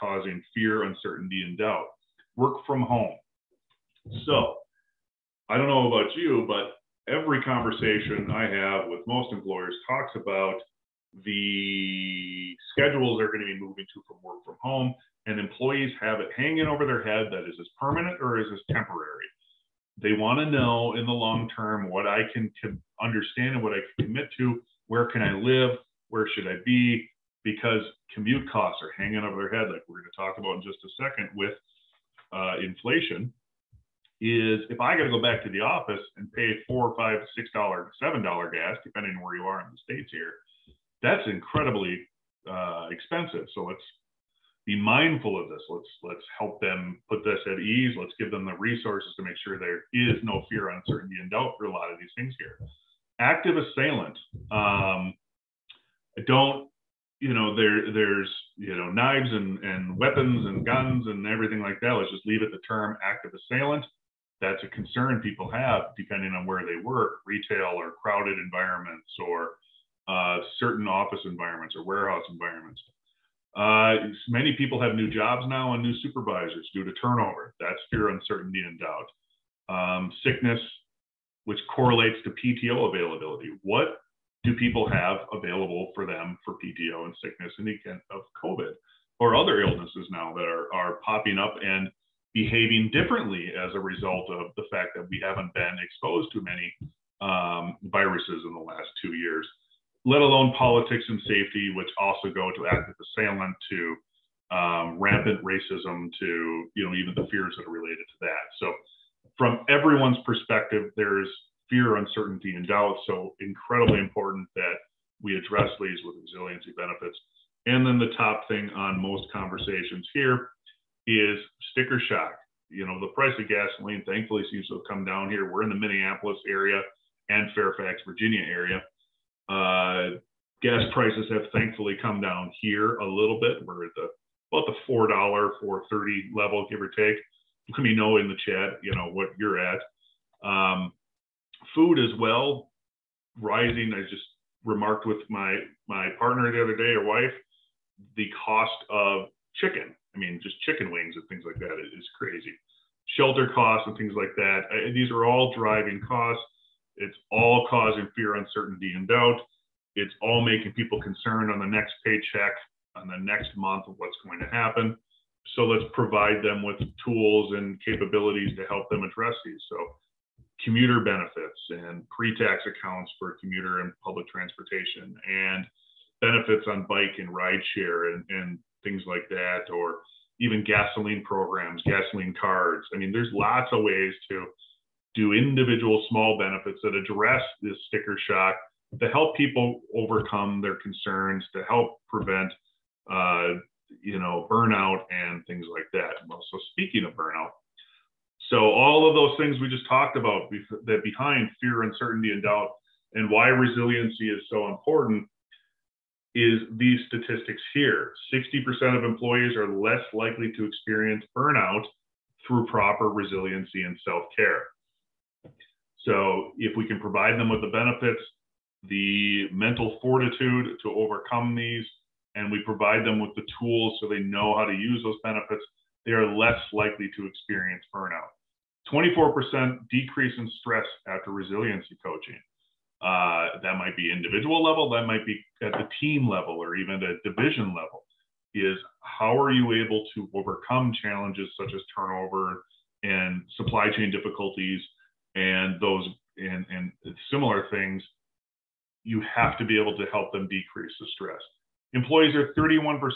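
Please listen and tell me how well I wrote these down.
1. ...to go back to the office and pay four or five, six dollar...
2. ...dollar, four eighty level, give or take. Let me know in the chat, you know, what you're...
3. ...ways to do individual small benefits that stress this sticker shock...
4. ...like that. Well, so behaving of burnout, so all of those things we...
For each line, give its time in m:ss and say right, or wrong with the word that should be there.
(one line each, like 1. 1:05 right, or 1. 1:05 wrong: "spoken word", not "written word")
1. 0:35 right
2. 2:15 wrong: "thirty", not "eighty"
3. 3:03 wrong: "address", not "stress"
4. 3:15 wrong: "speaking", not "behaving".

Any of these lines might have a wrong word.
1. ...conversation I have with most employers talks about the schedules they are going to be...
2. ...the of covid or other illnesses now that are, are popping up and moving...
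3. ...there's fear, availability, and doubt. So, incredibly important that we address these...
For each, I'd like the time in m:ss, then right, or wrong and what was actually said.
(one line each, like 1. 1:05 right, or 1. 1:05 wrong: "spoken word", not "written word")
1. 0:07 right
2. 1:27 wrong: "behaving", not "moving"
3. 1:50 wrong: "uncertainty", not "availability".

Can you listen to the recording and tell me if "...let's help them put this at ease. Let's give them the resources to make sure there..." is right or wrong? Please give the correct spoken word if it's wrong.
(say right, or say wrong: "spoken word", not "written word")
right.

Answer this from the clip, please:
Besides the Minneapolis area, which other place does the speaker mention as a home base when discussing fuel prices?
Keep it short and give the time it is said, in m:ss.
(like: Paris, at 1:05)
Fairfax, Virginia, at 2:07.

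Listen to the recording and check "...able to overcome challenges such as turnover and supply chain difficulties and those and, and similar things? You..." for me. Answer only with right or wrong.
right.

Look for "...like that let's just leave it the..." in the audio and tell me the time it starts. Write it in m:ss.
1:01.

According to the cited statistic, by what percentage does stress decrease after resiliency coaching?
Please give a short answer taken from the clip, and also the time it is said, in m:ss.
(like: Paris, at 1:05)
24%, at 3:48.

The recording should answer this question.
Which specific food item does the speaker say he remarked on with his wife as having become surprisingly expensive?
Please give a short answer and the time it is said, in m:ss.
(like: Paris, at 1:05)
Chicken wings, at 2:30.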